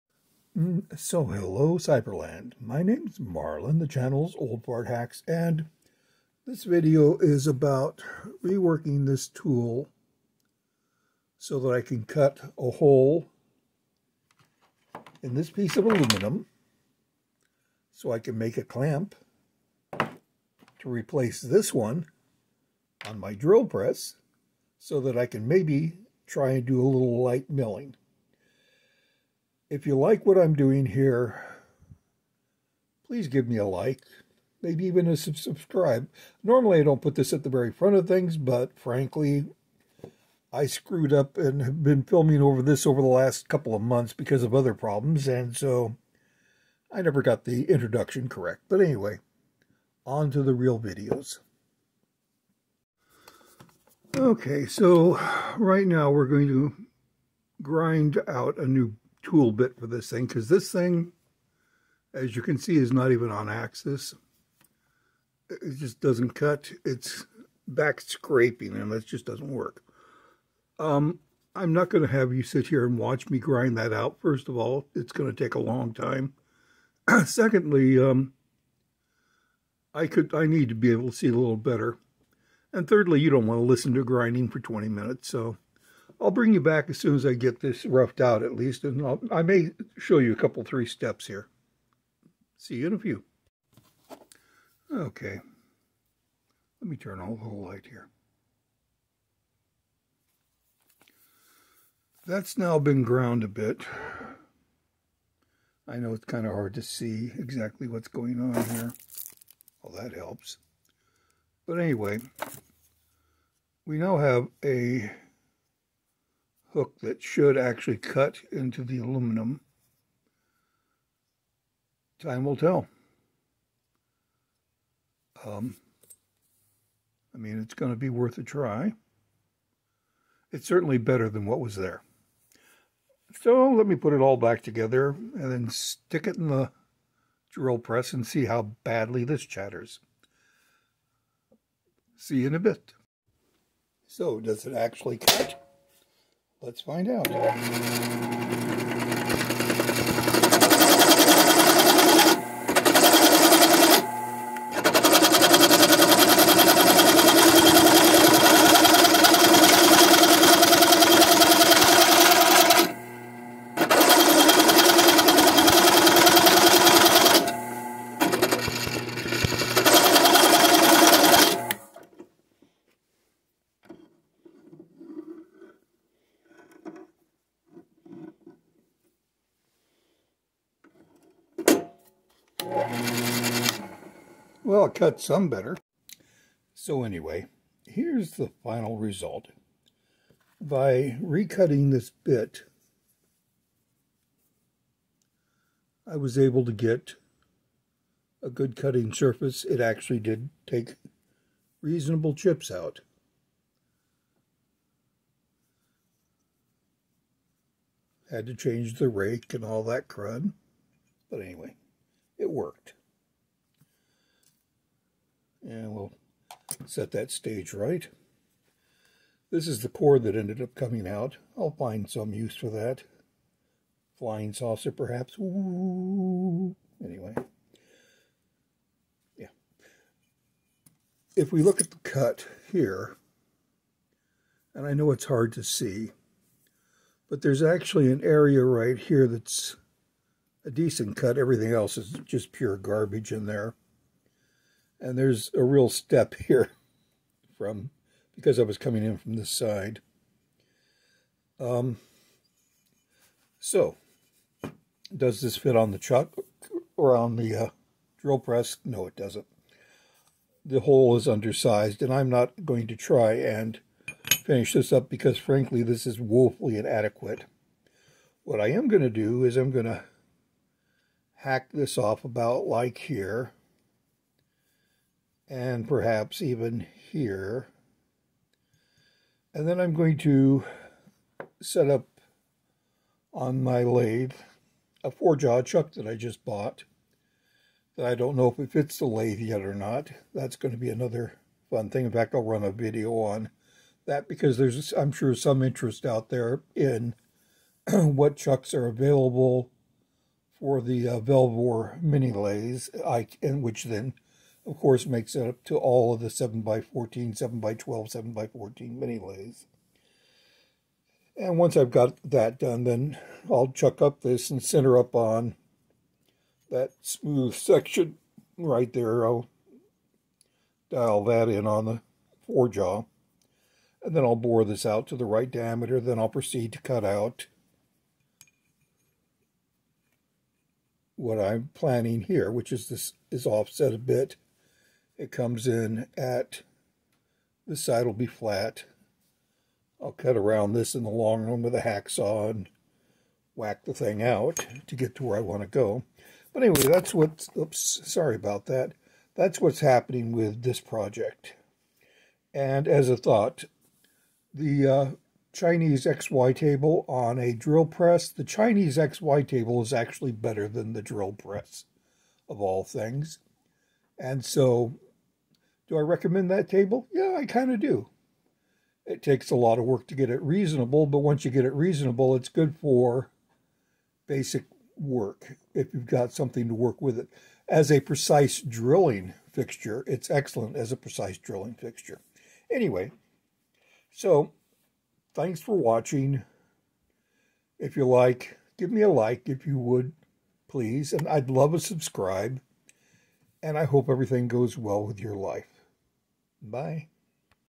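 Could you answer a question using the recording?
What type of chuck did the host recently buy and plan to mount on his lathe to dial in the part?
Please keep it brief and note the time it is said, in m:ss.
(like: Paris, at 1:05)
four-jaw chuck, at 4:45.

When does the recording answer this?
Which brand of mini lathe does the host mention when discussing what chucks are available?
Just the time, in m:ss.
5:01.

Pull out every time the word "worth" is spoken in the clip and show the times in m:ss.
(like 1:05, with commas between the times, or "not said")
2:08.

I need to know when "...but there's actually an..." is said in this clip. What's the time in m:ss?
3:57.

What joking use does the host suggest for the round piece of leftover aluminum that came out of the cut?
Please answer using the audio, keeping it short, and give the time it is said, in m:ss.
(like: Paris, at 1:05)
Flying saucer, at 3:44.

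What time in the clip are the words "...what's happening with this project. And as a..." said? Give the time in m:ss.
5:49.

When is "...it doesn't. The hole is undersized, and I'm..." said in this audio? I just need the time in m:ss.
4:19.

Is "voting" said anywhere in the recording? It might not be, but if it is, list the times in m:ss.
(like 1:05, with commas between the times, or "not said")
not said.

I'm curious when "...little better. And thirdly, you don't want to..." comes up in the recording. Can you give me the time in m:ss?
1:21.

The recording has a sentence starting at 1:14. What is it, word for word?
First of all, it's going to take a long time.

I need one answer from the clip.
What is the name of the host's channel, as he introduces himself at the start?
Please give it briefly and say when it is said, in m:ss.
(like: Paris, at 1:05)
Old Fart Hacks, at 0:04.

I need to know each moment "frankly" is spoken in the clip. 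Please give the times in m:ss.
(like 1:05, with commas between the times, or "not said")
0:38, 4:25.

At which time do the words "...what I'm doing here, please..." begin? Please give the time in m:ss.
0:30.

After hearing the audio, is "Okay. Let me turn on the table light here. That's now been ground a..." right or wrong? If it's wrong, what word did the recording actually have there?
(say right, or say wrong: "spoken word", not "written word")
wrong: "whole", not "table".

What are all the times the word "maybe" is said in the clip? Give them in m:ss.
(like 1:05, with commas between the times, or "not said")
0:25, 0:34.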